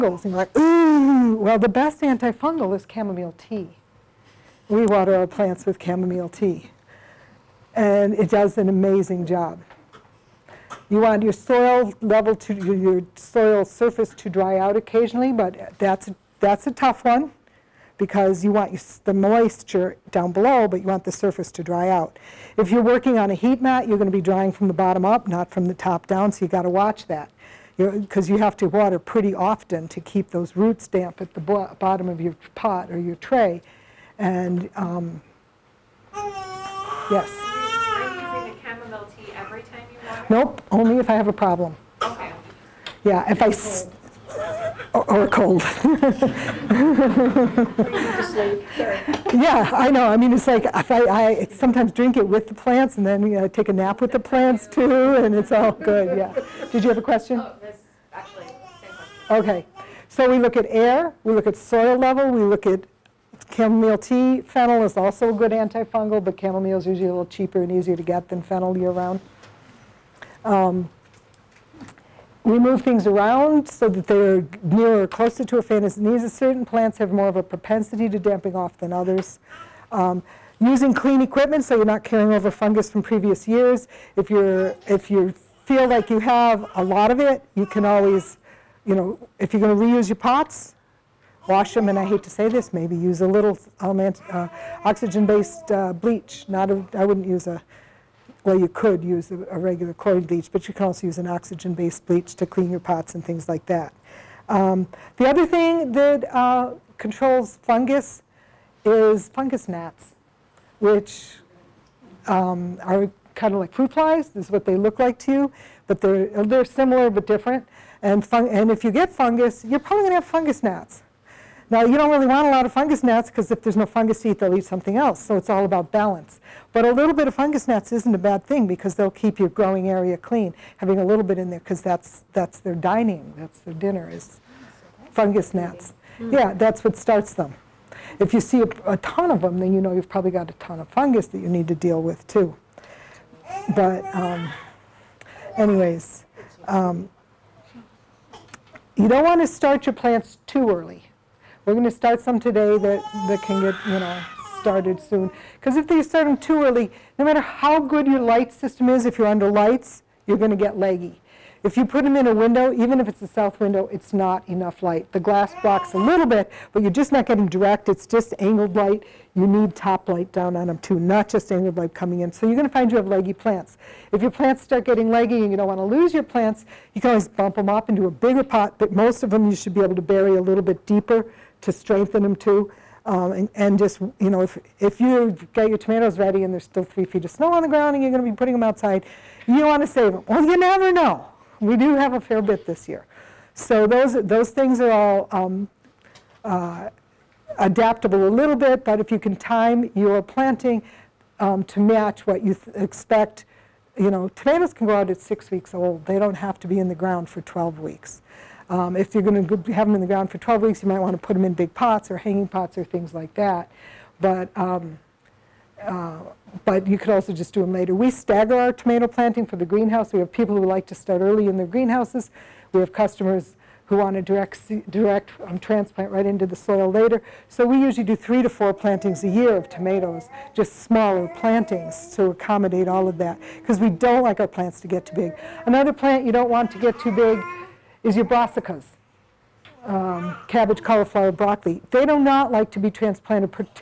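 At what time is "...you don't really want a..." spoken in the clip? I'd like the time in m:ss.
2:01.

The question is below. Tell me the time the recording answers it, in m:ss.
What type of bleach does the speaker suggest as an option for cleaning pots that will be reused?
1:34.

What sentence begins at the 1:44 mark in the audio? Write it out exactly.
Um, the other thing that uh, controls fungus is fungus gnats, which um, are kind of like fruit flies.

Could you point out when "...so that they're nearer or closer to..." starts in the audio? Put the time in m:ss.
1:13.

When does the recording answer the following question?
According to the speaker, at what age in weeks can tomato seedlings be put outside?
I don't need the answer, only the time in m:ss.
3:25.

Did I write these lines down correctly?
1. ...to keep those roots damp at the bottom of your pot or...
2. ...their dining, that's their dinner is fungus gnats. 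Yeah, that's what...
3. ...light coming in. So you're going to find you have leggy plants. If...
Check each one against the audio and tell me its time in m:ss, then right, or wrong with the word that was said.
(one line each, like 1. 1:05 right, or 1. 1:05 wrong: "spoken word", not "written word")
1. 0:29 right
2. 2:12 right
3. 2:51 right.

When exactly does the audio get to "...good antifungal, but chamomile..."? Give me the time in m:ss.
1:05.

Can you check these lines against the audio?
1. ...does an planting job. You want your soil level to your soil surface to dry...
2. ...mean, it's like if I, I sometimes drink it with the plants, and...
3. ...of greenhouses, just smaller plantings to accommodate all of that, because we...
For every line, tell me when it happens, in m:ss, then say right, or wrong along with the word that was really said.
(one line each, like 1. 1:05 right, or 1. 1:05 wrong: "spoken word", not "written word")
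1. 0:08 wrong: "amazing", not "planting"
2. 0:50 right
3. 3:49 wrong: "tomatoes", not "greenhouses".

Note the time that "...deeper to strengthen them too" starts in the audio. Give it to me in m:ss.
3:00.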